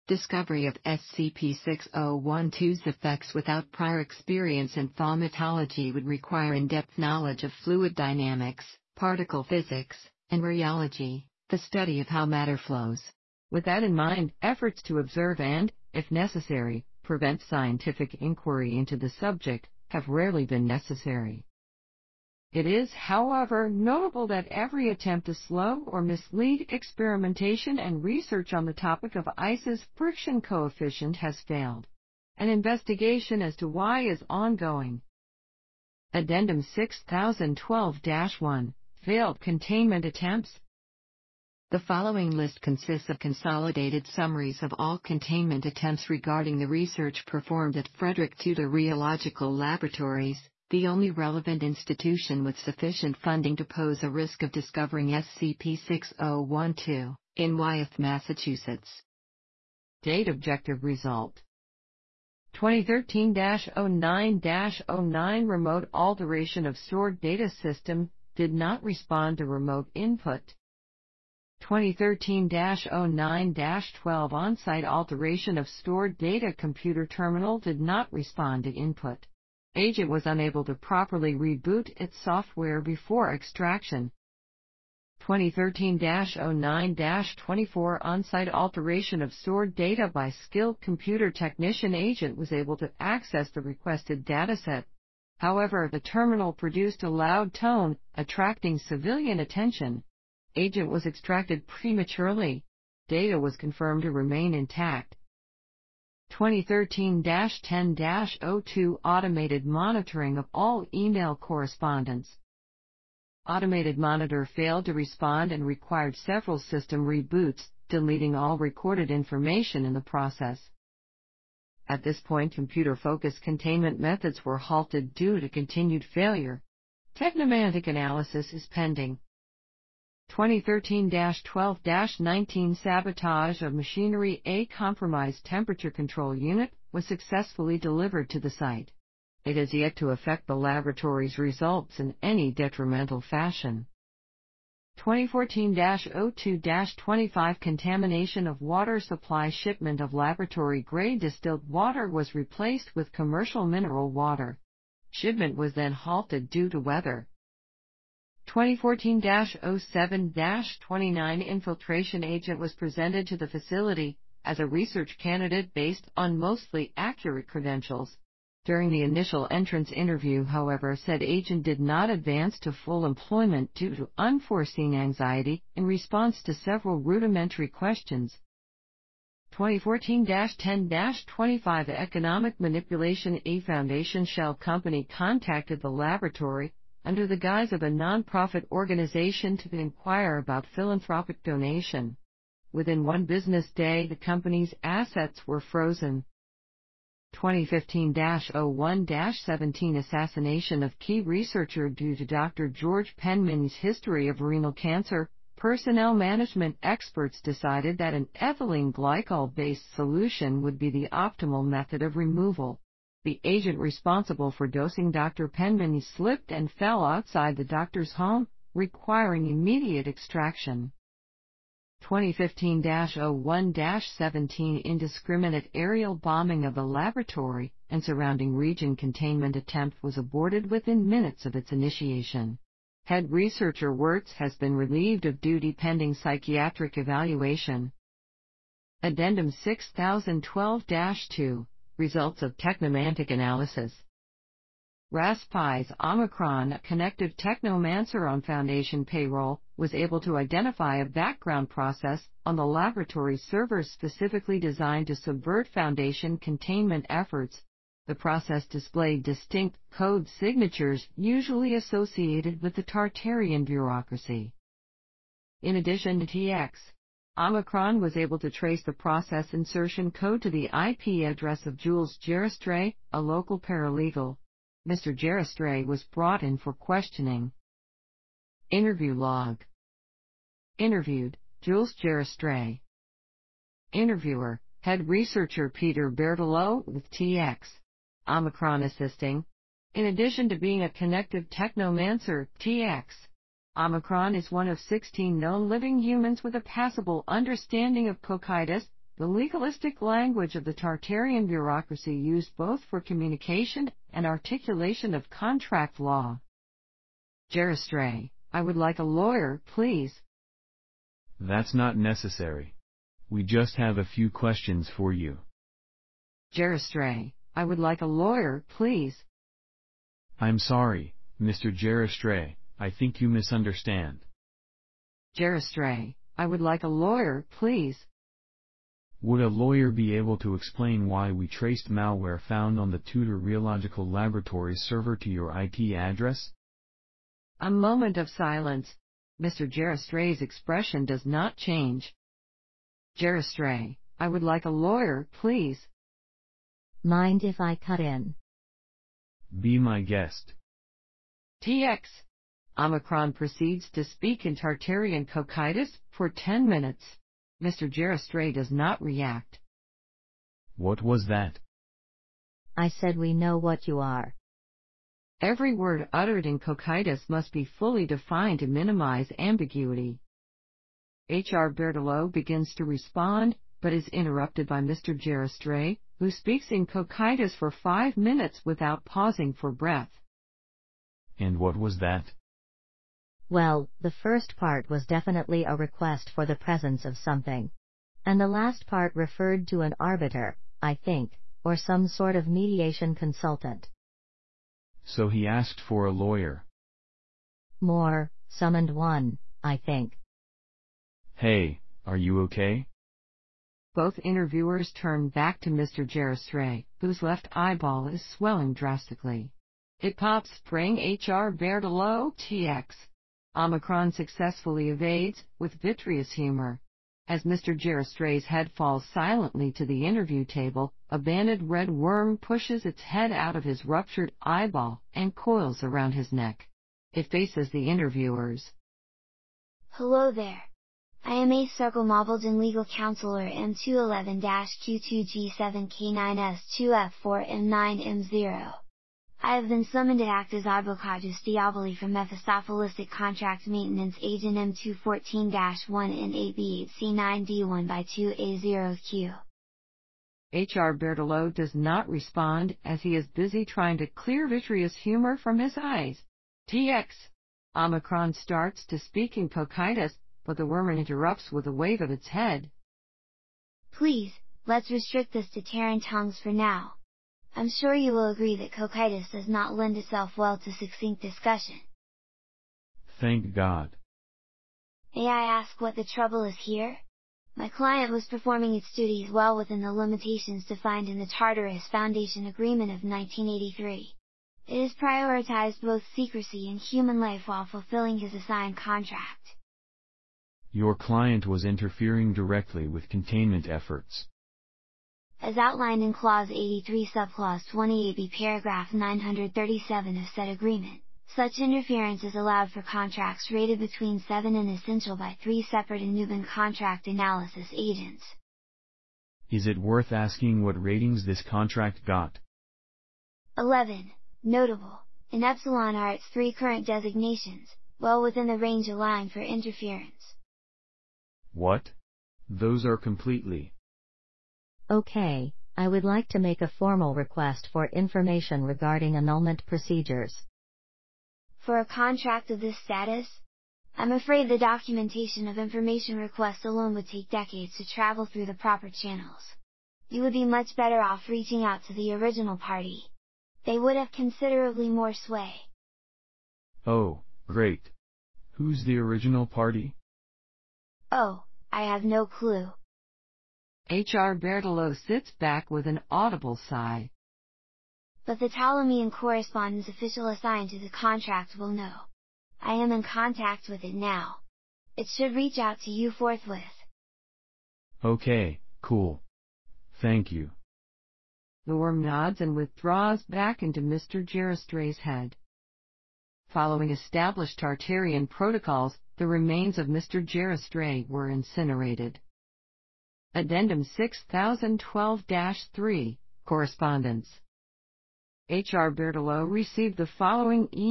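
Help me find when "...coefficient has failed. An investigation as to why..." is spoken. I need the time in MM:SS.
00:30.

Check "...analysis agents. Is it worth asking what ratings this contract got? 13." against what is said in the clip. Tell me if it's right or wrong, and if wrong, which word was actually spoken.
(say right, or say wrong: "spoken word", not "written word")
wrong: "11", not "13".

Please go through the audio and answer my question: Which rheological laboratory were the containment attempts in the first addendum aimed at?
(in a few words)
Frederick Tudor Rheological Laboratories.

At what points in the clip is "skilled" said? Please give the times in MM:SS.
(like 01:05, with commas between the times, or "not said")
01:30.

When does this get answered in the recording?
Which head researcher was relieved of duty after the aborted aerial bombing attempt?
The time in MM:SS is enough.
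03:53.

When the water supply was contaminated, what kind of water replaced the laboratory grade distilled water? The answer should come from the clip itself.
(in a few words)
Commercial mineral water.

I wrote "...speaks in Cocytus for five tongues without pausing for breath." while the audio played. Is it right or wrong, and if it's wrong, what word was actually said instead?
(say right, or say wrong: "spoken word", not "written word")
wrong: "minutes", not "tongues".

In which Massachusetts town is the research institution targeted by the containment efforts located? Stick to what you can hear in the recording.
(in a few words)
Wyeth.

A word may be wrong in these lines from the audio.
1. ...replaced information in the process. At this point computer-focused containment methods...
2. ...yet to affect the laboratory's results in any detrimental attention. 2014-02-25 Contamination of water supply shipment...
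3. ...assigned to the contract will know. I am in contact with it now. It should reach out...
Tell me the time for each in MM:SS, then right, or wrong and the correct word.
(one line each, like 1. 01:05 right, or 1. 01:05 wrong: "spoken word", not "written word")
1. 01:58 wrong: "recorded", not "replaced"
2. 02:19 wrong: "fashion", not "attention"
3. 09:20 right.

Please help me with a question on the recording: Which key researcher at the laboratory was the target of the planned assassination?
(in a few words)
Dr. George Penman.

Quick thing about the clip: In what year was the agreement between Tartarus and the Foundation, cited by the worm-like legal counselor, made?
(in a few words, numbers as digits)
1983.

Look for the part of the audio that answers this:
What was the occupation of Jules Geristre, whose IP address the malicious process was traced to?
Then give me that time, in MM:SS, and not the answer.
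04:33.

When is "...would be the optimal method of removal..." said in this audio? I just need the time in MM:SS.
03:30.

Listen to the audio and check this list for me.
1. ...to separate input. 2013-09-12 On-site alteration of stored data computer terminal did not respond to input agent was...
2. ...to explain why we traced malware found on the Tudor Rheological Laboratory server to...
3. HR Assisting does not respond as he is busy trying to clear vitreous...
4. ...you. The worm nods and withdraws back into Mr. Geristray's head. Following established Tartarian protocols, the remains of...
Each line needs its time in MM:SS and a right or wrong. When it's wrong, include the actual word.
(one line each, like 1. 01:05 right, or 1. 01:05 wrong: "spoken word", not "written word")
1. 01:09 wrong: "remote", not "separate"
2. 05:30 right
3. 07:30 wrong: "Bertolo", not "Assisting"
4. 09:30 right.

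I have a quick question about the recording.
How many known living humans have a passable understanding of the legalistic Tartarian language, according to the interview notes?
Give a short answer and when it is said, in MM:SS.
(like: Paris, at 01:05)
16, at 04:54.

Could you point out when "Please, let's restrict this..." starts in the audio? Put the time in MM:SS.
07:43.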